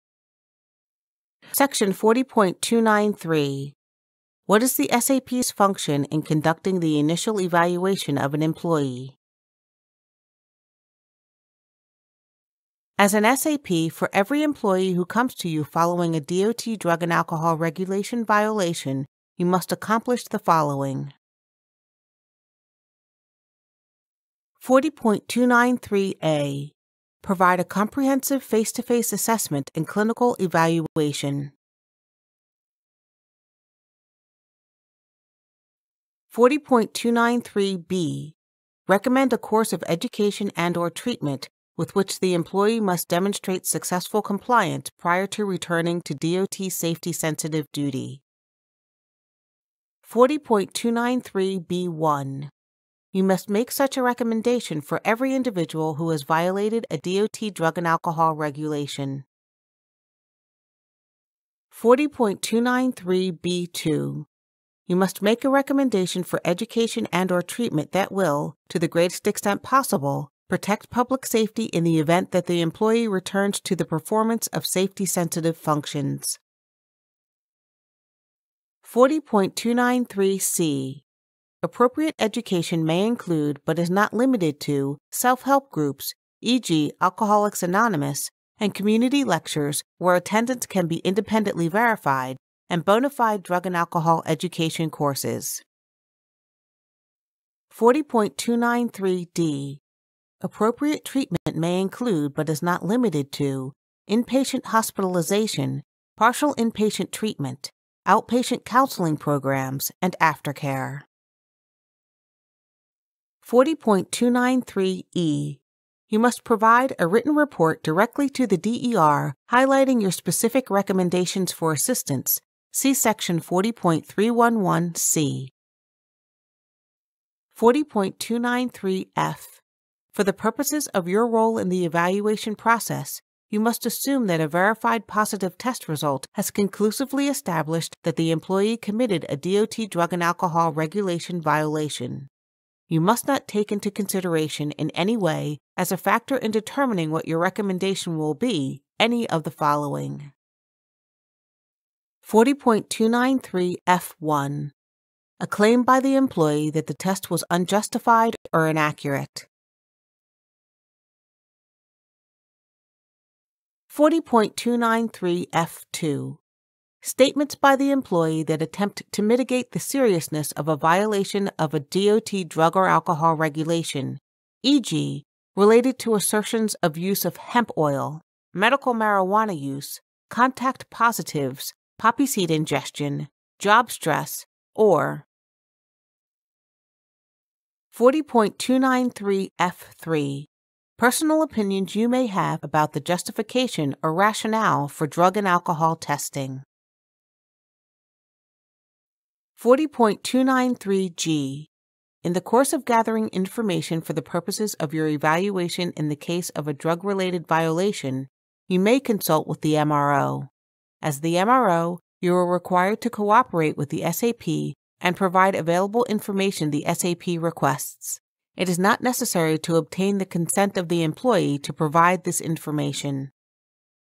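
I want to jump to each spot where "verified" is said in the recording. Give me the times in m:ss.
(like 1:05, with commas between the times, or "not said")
1:31, 2:14.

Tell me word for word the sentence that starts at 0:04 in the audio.
What is the SAP's function in conducting the initial evaluation of an employee?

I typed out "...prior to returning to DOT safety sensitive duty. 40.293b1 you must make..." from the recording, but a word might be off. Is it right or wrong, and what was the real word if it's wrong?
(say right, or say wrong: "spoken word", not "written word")
right.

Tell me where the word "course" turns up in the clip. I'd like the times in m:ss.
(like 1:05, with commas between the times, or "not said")
0:39, 1:34, 3:22.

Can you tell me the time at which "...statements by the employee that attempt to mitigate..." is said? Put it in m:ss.
2:47.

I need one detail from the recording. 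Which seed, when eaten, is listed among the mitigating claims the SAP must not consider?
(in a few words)
poppy seed.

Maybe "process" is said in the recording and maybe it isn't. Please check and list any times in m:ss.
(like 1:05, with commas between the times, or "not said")
2:12.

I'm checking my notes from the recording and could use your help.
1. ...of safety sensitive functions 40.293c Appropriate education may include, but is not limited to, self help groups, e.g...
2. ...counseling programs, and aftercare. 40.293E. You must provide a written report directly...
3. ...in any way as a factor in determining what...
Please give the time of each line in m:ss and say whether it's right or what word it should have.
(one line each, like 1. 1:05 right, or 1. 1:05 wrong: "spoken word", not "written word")
1. 1:14 right
2. 1:48 right
3. 2:24 right.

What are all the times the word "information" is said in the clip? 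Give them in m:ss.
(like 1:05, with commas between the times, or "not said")
3:23, 3:36, 3:42.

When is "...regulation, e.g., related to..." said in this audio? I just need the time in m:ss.
2:53.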